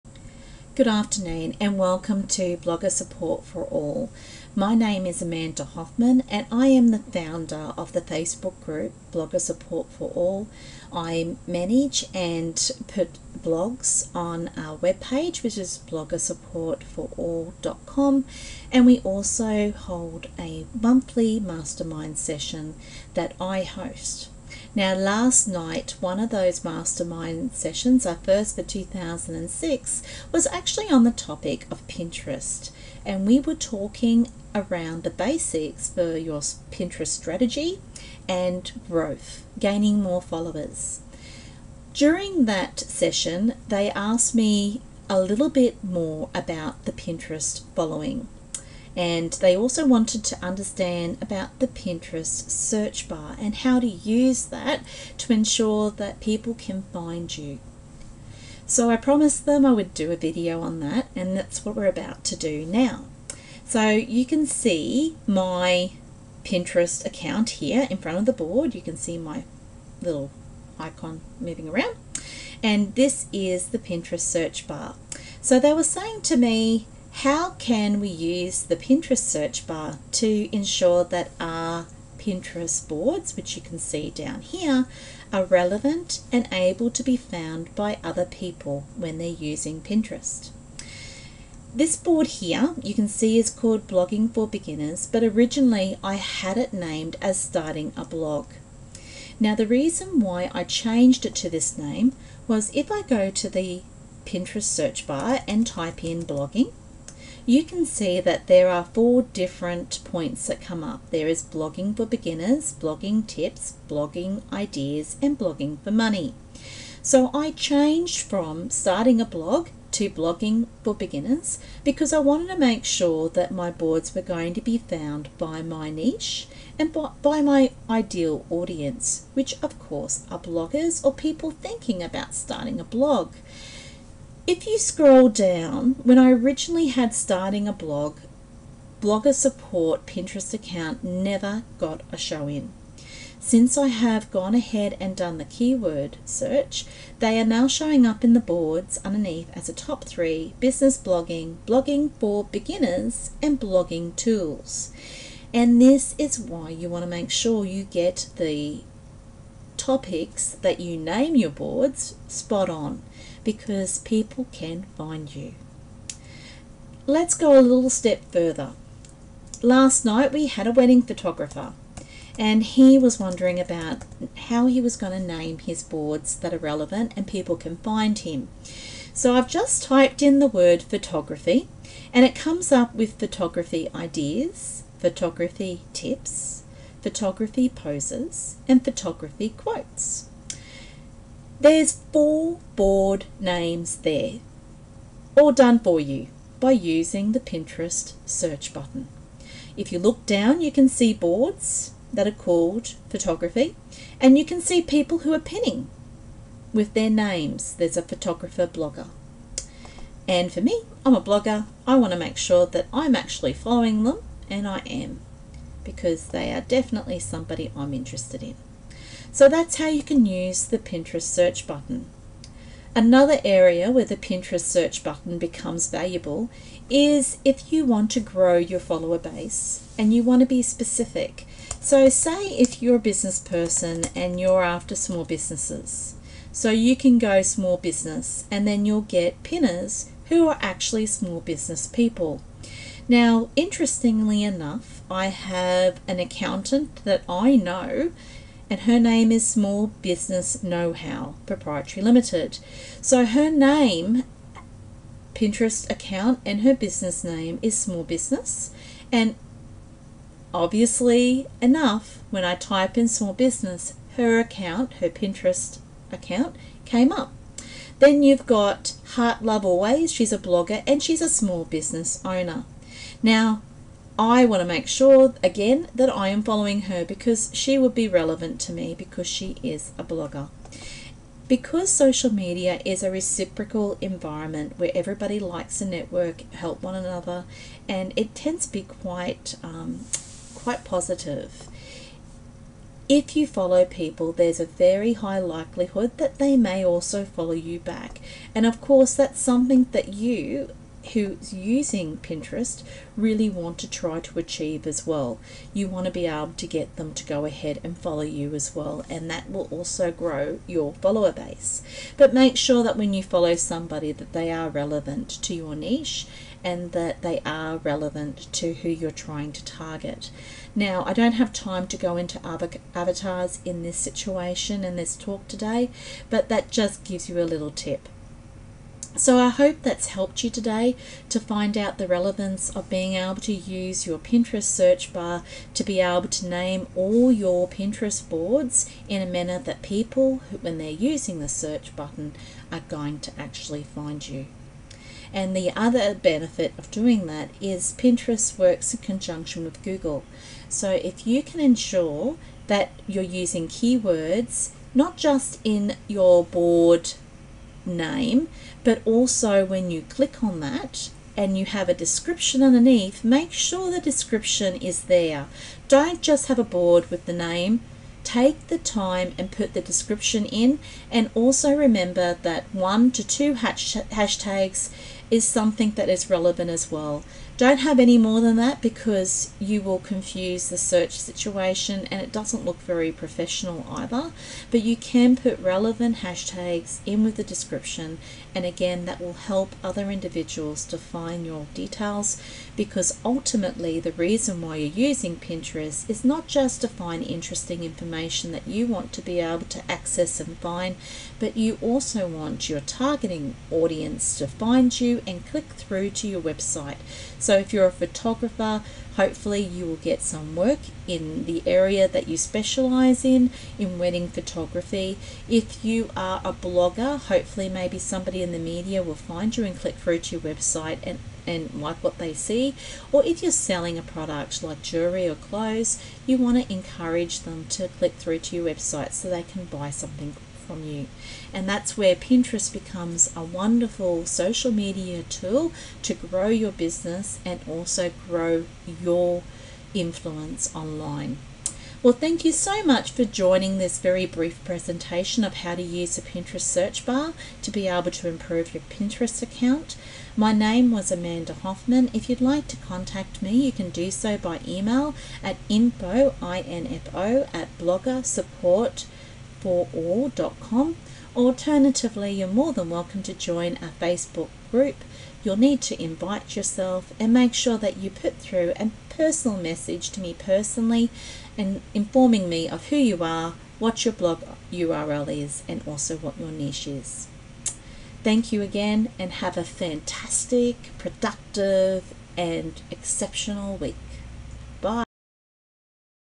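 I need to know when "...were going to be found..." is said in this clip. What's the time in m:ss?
2:04.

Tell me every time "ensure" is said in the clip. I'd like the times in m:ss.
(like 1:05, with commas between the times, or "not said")
0:55, 1:20, 5:51.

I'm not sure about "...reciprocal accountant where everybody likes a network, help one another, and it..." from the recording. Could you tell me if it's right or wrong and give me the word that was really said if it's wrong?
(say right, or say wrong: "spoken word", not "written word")
wrong: "environment", not "accountant".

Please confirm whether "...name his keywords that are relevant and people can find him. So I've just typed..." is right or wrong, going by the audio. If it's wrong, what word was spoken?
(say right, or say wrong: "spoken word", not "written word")
wrong: "boards", not "keywords".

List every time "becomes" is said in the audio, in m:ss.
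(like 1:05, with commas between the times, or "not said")
3:45, 7:12.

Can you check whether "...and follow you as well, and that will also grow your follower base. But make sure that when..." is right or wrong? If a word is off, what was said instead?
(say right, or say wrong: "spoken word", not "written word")
right.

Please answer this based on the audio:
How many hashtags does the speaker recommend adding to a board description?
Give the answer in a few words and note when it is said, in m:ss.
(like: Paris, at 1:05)
1 to 2, at 6:12.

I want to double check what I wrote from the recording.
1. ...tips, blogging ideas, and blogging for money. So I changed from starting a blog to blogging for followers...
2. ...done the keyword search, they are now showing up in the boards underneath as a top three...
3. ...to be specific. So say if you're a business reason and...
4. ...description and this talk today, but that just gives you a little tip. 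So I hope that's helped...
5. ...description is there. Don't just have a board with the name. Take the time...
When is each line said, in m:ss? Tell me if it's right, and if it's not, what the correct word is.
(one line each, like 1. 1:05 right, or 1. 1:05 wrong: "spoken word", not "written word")
1. 1:53 wrong: "beginners", not "followers"
2. 2:25 right
3. 3:50 wrong: "person", not "reason"
4. 5:23 wrong: "situation", not "description"
5. 6:04 right.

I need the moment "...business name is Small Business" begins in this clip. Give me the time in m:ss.
4:16.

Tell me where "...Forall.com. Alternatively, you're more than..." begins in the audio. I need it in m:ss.
7:39.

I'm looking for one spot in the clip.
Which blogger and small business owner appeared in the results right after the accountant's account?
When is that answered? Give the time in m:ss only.
4:29.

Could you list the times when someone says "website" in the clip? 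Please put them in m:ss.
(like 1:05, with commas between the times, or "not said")
6:46, 7:00, 7:08.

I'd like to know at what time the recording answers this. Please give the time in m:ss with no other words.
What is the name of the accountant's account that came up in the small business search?
4:09.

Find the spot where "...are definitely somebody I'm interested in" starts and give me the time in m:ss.
3:36.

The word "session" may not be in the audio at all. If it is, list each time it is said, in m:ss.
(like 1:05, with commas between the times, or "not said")
0:22, 0:27, 0:42.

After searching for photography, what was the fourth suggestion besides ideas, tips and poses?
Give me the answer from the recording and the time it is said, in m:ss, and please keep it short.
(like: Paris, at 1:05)
Photography quotes, at 3:08.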